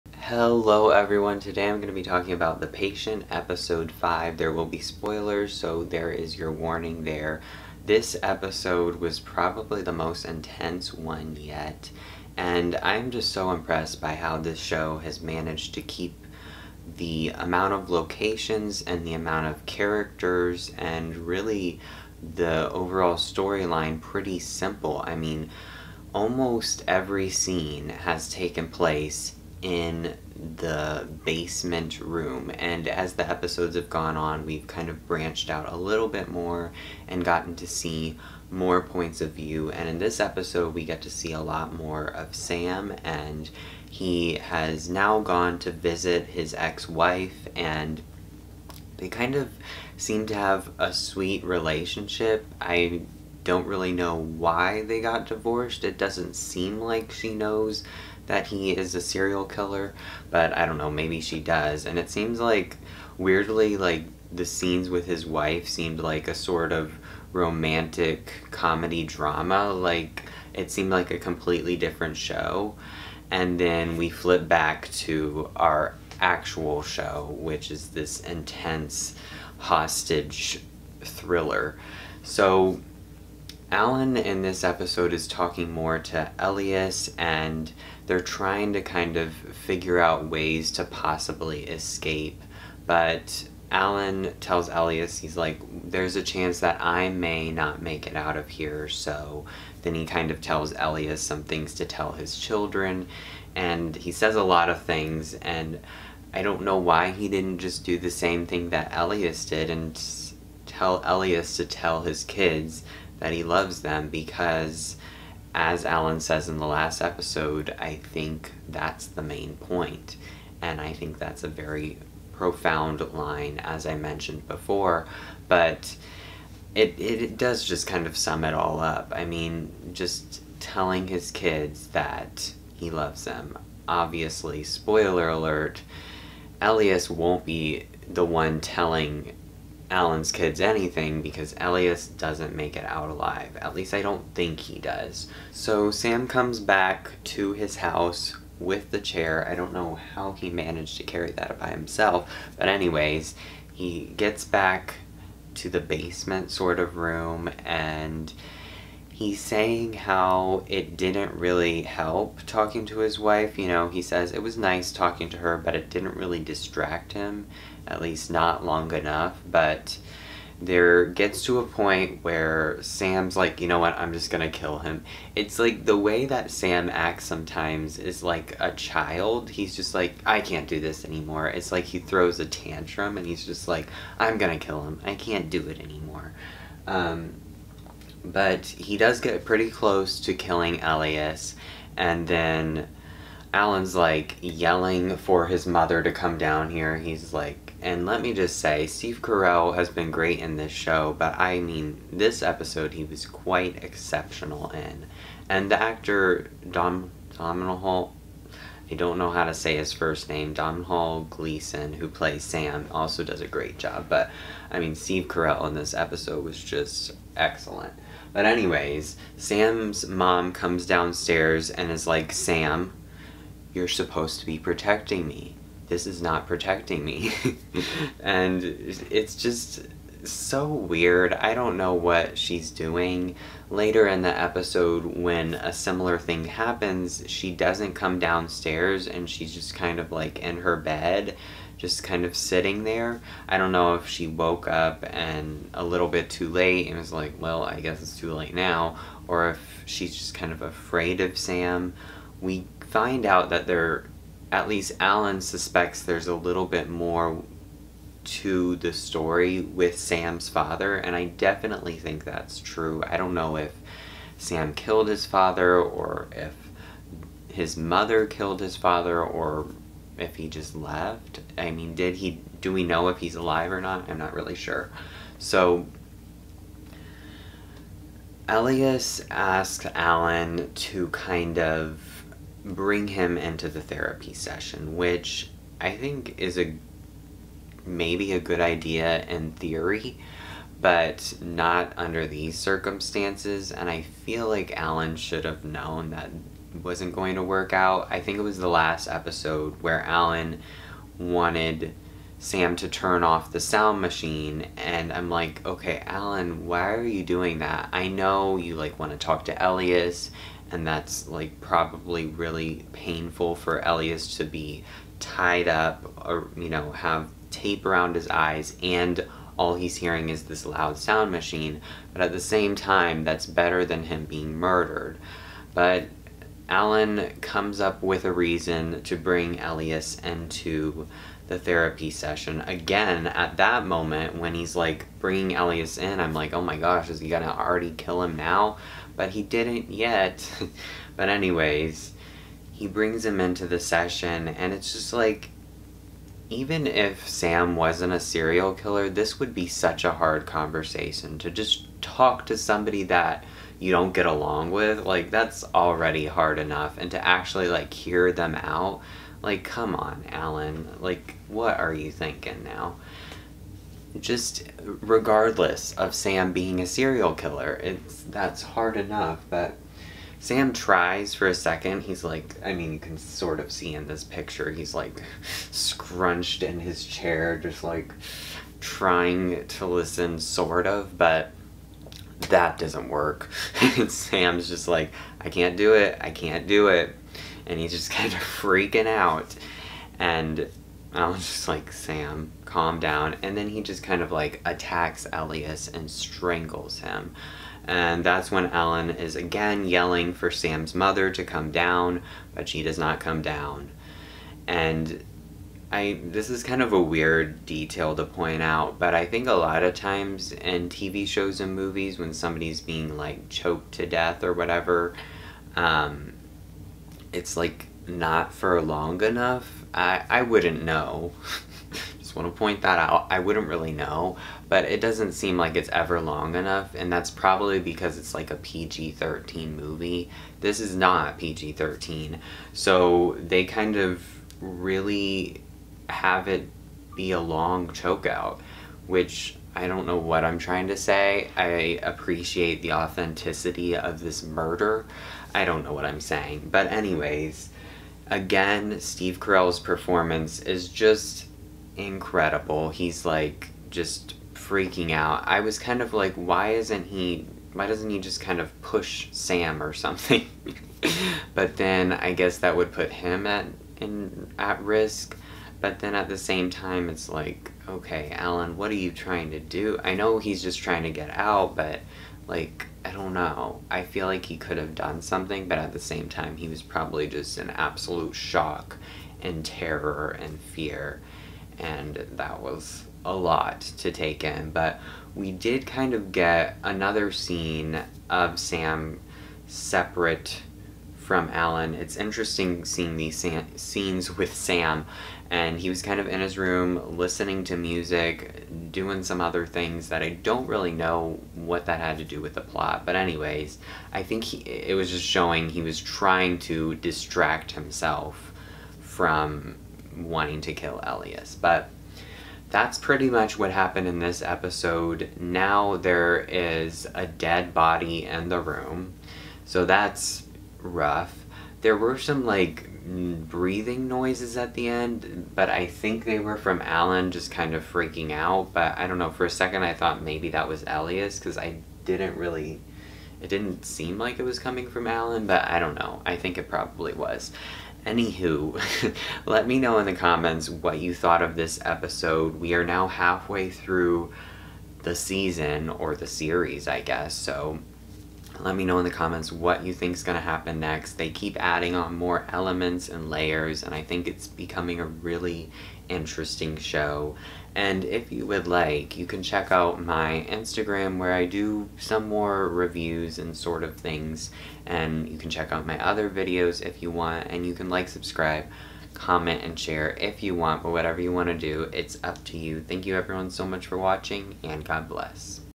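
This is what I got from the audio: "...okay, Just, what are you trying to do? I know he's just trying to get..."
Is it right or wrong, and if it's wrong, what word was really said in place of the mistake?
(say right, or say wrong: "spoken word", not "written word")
wrong: "Alan", not "Just".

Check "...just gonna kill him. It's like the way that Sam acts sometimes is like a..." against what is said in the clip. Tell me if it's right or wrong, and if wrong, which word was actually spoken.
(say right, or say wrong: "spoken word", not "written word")
right.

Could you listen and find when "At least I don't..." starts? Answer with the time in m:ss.
2:23.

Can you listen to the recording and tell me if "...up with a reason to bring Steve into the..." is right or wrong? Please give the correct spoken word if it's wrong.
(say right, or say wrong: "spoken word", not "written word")
wrong: "Elias", not "Steve".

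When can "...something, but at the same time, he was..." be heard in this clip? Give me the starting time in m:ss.
7:55.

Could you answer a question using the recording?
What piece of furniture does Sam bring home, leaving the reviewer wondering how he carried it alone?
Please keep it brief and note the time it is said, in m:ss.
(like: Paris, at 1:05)
the chair, at 2:28.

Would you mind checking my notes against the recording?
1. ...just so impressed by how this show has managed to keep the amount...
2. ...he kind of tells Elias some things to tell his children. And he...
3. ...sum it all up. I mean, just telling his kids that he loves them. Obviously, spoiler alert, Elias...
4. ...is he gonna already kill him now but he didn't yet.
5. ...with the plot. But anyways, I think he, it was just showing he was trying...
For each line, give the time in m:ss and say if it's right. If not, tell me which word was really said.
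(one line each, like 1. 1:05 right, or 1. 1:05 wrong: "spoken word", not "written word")
1. 0:13 right
2. 1:39 right
3. 2:08 right
4. 5:37 right
5. 8:22 right.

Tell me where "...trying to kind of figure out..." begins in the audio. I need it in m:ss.
1:28.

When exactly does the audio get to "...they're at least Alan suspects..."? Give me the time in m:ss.
4:13.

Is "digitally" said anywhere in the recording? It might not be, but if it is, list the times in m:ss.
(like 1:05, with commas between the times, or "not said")
not said.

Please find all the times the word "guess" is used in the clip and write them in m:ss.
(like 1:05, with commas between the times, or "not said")
4:07, 7:42, 9:07.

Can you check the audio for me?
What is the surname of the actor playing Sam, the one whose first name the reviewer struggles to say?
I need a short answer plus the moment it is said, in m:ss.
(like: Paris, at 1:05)
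Gleeson, at 3:31.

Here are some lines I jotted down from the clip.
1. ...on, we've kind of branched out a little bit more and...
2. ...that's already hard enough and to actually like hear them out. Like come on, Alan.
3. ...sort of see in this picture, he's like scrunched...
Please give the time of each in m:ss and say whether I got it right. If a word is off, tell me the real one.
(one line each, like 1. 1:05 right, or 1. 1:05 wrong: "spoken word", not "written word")
1. 0:34 right
2. 5:55 right
3. 6:13 right.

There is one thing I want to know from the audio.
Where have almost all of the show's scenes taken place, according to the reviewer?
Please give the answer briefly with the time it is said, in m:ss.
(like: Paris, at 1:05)
the basement room, at 0:30.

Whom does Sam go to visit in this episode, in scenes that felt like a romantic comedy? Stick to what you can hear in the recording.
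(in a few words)
his ex wife.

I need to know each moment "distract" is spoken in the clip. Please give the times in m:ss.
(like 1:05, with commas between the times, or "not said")
2:46, 8:26.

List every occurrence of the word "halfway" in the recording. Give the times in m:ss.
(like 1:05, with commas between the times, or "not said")
9:03.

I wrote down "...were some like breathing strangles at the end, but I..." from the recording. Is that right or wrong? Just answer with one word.
wrong.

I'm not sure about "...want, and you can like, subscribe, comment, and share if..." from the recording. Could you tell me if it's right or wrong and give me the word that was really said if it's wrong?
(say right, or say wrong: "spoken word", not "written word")
right.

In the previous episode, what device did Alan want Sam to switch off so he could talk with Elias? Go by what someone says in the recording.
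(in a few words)
the sound machine.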